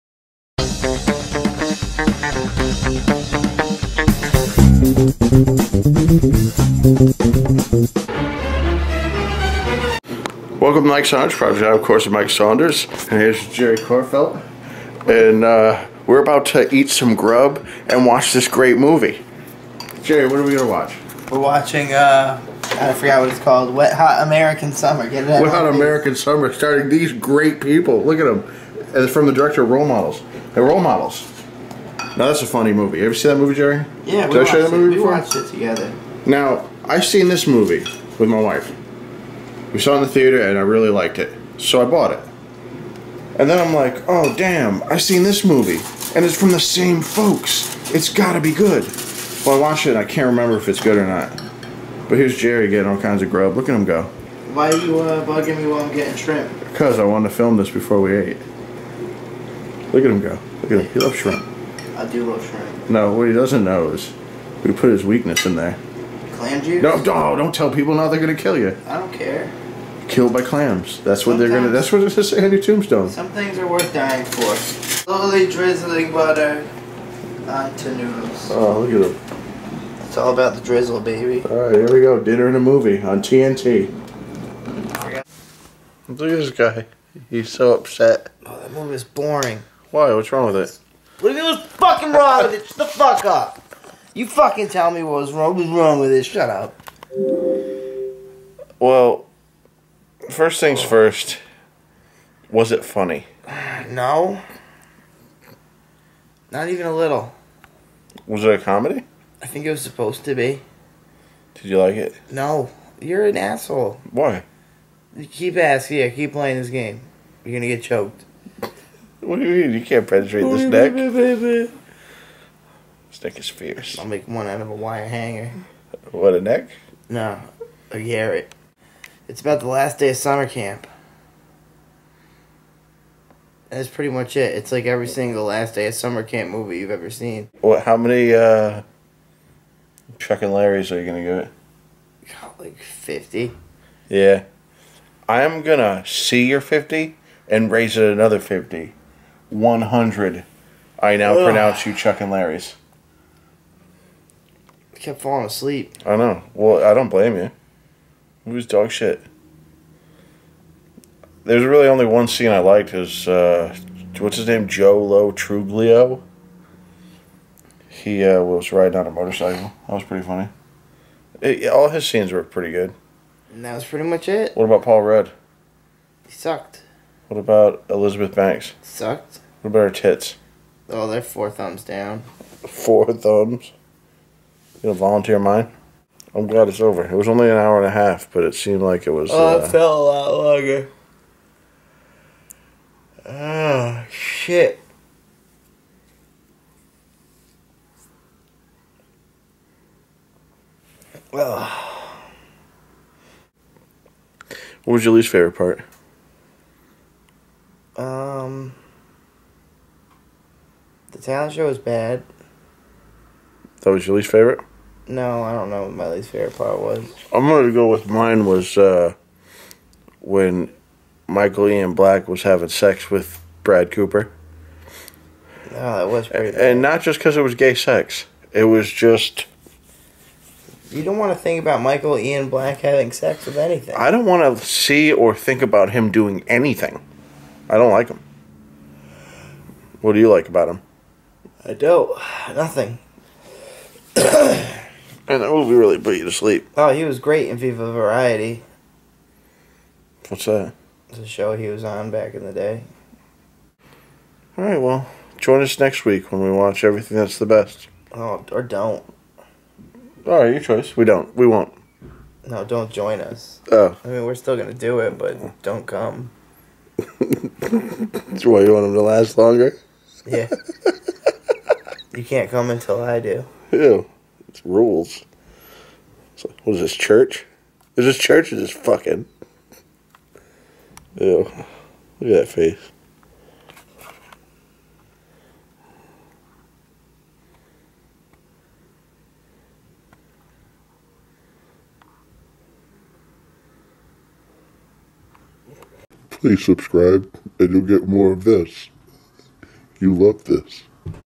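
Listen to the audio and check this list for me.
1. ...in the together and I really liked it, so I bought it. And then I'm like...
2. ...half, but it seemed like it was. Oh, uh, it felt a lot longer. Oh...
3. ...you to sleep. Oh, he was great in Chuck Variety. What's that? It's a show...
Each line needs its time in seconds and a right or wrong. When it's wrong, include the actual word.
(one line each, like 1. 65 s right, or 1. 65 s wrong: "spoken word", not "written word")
1. 39 s wrong: "theater", not "together"
2. 187 s right
3. 246 s wrong: "Viva", not "Chuck".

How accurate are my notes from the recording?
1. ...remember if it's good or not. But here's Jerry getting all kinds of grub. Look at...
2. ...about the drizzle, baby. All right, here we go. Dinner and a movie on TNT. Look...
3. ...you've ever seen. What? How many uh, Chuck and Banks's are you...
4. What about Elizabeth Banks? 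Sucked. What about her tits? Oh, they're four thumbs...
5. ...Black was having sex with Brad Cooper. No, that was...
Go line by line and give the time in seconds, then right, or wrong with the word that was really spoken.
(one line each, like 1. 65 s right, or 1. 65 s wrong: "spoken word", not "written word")
1. 50 s right
2. 80 s right
3. 136 s wrong: "Larry", not "Banks"
4. 177 s right
5. 221 s right.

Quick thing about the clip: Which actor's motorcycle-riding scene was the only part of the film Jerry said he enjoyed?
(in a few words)
Joe Lo Truglio.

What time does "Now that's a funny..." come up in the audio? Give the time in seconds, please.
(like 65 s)
32 s.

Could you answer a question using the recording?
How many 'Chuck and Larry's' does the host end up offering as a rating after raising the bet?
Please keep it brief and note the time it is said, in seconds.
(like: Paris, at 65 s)
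100, at 149 s.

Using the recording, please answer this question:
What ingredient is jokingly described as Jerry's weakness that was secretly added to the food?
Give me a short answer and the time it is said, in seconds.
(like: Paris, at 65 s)
Clam juice, at 66 s.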